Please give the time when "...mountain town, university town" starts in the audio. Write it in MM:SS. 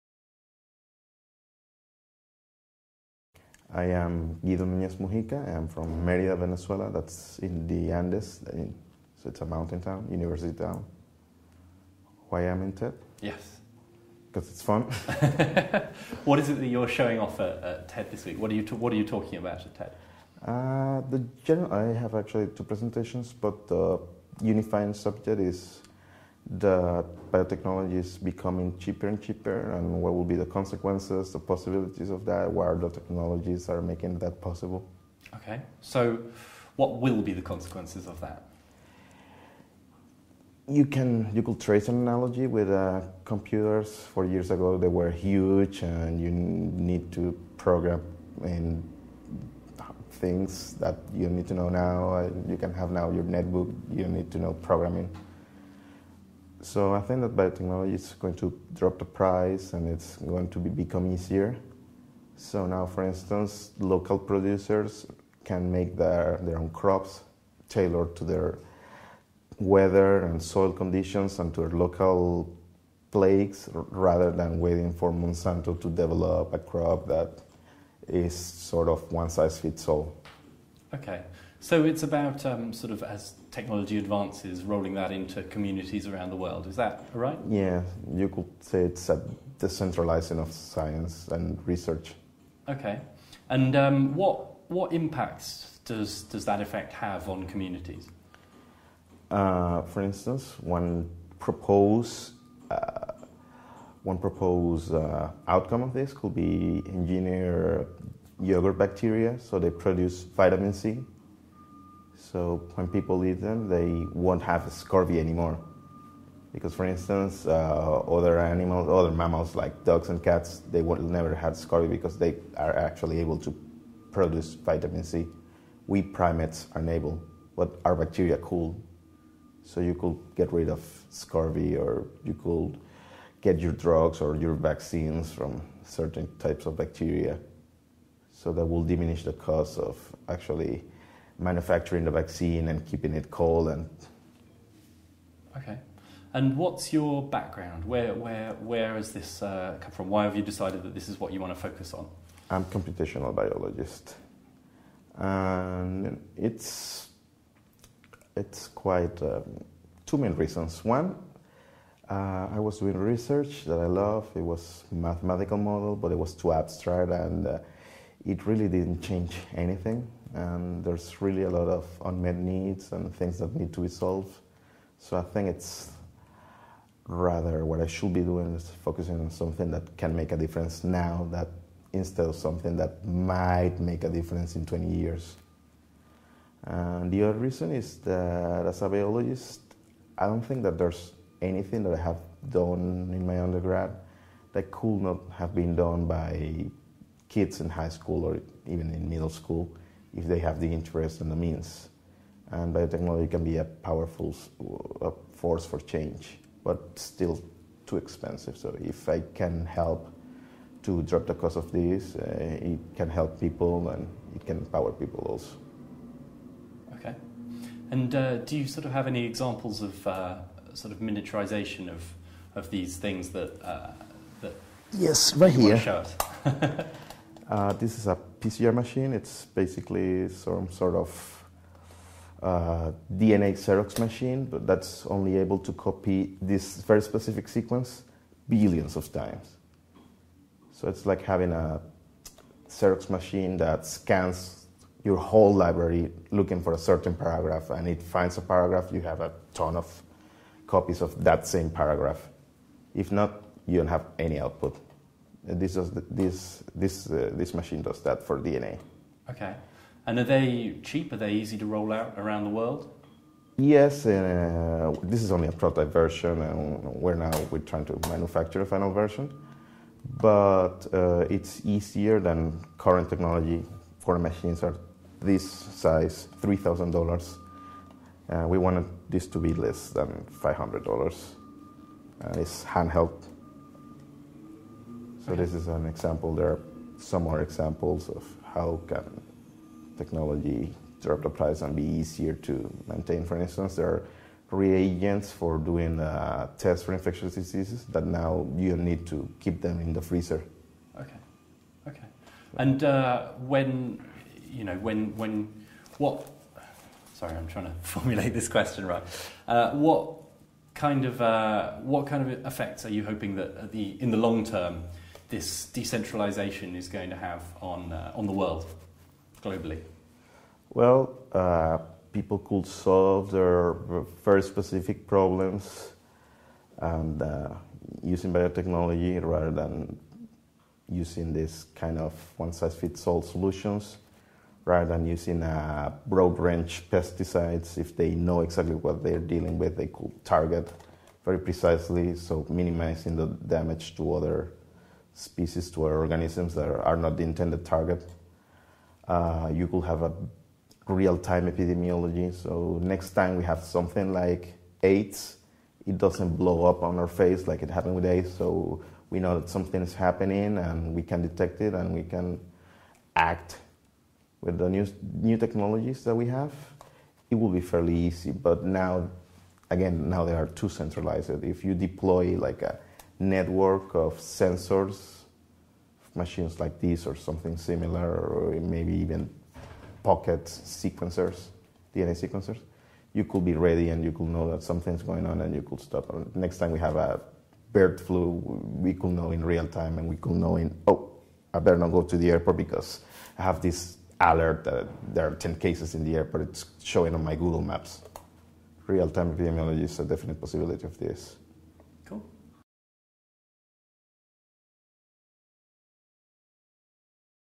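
00:09.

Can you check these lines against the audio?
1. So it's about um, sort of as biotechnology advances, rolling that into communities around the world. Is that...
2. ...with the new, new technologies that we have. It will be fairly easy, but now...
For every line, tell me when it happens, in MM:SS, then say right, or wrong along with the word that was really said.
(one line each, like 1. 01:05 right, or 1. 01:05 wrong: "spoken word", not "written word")
1. 01:21 wrong: "technology", not "biotechnology"
2. 06:04 right.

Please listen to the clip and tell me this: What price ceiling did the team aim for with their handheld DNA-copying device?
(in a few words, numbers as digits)
$500.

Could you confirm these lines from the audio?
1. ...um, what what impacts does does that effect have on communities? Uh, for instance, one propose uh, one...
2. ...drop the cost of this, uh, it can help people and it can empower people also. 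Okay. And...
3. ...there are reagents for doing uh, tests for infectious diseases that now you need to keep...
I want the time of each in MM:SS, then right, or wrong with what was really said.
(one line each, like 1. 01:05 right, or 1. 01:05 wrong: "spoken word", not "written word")
1. 01:33 right
2. 03:31 right
3. 04:53 right.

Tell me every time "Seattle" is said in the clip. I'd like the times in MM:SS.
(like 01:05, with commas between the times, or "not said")
not said.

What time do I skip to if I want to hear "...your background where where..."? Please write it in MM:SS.
02:26.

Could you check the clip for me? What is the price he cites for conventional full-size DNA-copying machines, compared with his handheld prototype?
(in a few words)
$3,000.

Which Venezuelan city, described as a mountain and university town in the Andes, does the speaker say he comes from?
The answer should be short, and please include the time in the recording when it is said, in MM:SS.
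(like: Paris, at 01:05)
Merida, at 00:06.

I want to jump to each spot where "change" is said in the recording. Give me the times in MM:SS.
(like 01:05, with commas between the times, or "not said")
02:49, 03:25.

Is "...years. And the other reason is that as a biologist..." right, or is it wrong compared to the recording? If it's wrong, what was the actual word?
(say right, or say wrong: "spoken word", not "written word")
right.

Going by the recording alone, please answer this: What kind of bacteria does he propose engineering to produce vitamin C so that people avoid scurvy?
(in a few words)
yogurt bacteria.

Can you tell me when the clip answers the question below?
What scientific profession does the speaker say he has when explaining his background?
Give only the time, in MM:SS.
02:32.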